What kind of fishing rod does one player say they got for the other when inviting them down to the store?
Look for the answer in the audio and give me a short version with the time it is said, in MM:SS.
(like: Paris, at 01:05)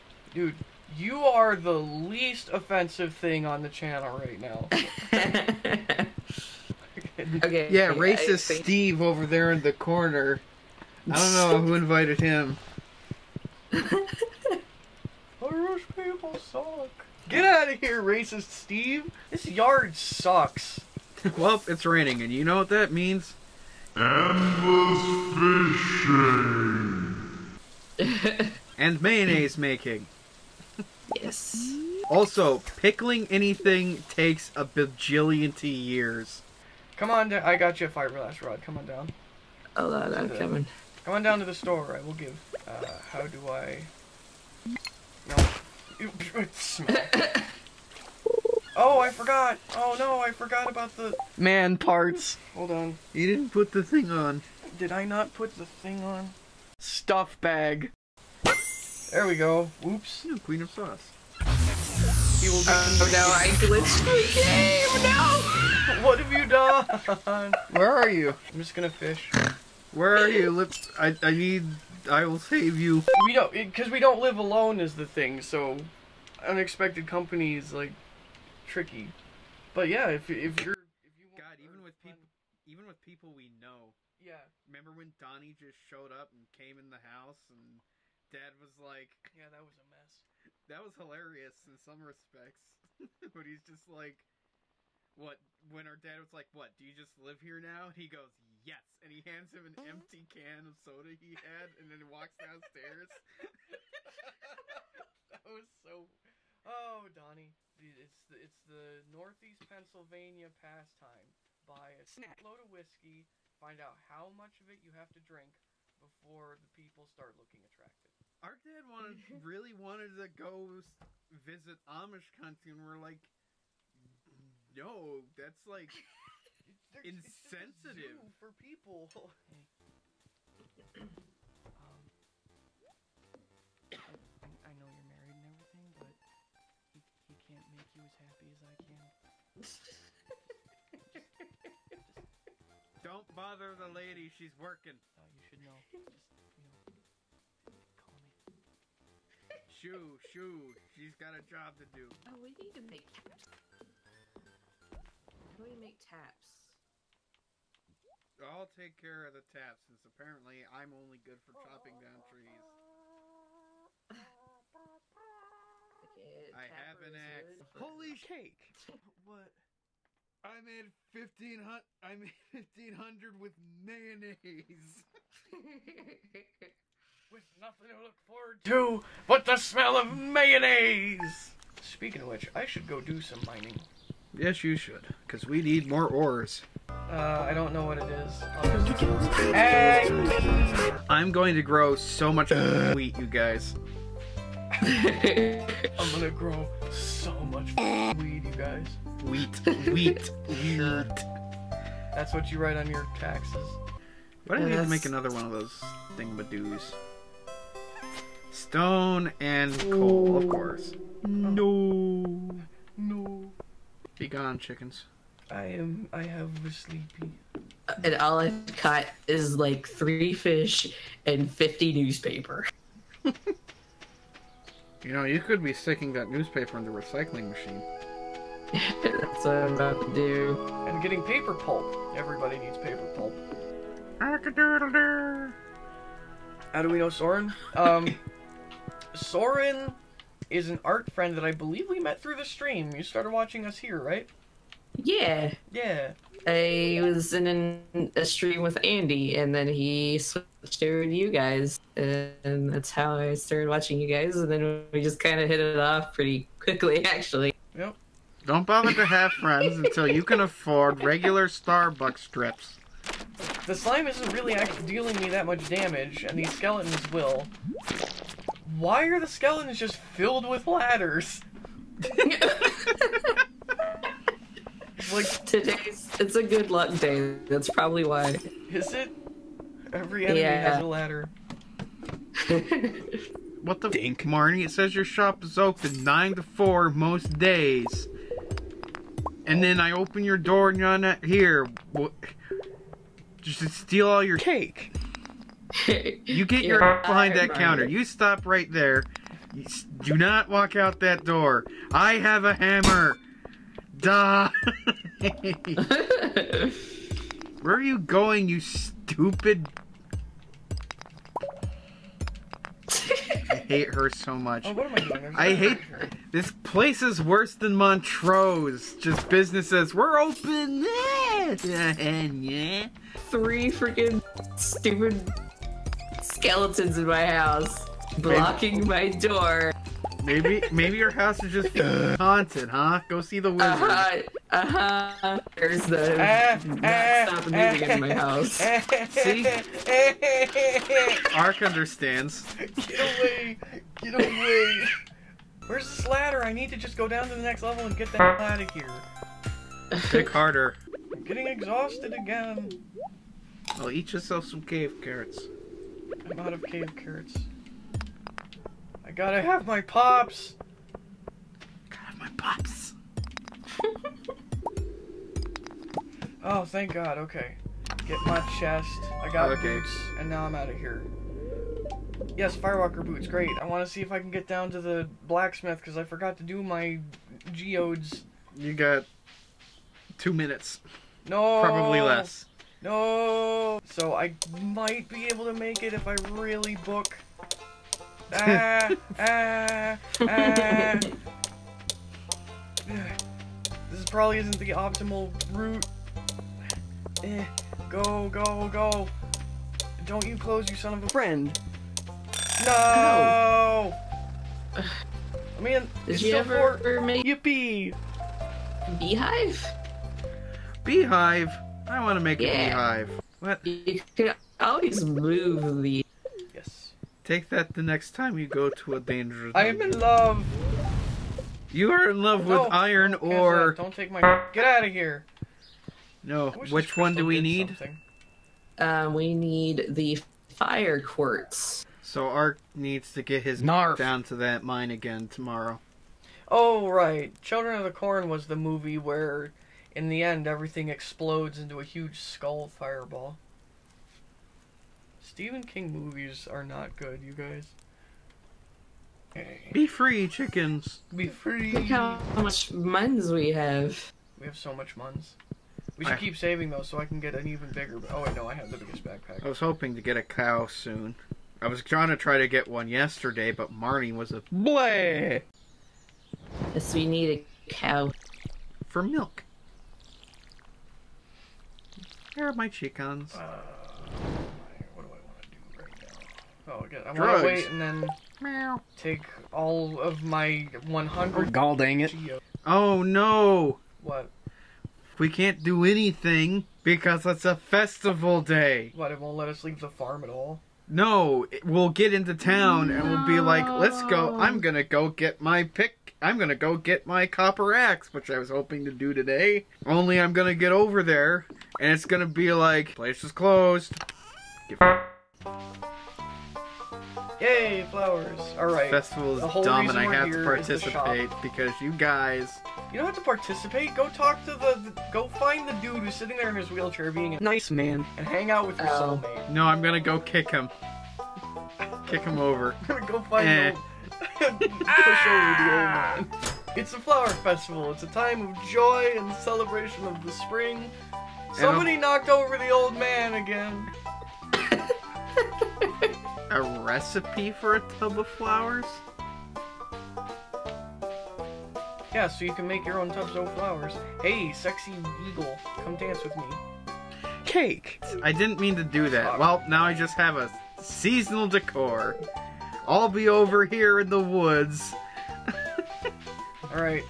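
Fiberglass rod, at 00:37.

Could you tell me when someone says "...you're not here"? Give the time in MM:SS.
04:50.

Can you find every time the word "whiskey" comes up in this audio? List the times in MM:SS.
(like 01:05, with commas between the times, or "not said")
01:52.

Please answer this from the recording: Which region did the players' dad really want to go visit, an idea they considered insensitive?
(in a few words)
Amish country.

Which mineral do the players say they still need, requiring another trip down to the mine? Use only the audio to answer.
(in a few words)
Fire quartz.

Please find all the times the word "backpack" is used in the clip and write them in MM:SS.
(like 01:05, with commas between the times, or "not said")
07:39.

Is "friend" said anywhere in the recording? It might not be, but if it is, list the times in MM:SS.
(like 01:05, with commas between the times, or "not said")
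04:01, 04:19, 06:41.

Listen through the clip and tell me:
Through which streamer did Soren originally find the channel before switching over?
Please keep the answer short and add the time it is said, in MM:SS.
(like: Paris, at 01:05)
Andy, at 04:08.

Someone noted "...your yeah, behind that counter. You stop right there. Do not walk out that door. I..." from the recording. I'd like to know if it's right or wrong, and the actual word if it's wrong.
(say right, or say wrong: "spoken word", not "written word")
right.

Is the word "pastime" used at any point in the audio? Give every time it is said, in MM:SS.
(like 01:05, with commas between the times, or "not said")
01:50.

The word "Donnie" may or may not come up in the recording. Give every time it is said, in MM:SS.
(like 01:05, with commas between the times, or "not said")
01:25, 01:47.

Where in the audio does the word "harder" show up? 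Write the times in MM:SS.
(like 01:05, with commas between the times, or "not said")
05:50.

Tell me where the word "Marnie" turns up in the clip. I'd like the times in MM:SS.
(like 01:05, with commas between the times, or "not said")
04:44, 07:43.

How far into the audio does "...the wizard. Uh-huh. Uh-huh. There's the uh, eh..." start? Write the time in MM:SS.
05:33.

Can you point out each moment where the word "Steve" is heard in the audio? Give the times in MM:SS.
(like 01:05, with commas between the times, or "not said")
00:08, 00:18.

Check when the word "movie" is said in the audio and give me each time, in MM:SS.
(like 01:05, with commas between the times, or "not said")
07:18, 07:25.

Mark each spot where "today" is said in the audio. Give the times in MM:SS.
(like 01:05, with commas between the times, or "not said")
04:35, 08:19.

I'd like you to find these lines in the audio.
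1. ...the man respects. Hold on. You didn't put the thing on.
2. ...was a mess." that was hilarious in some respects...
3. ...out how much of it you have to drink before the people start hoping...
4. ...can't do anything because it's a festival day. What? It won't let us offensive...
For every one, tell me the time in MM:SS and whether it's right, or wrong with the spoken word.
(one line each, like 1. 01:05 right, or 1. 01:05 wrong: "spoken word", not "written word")
1. 00:50 wrong: "parts", not "respects"
2. 01:29 right
3. 01:53 wrong: "looking", not "hoping"
4. 08:05 wrong: "leave", not "offensive".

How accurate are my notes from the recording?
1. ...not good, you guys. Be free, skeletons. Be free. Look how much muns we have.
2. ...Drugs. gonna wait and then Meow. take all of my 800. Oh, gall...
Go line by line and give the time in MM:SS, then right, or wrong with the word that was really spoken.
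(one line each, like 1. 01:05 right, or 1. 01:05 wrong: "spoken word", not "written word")
1. 07:26 wrong: "chickens", not "skeletons"
2. 07:57 wrong: "100", not "800".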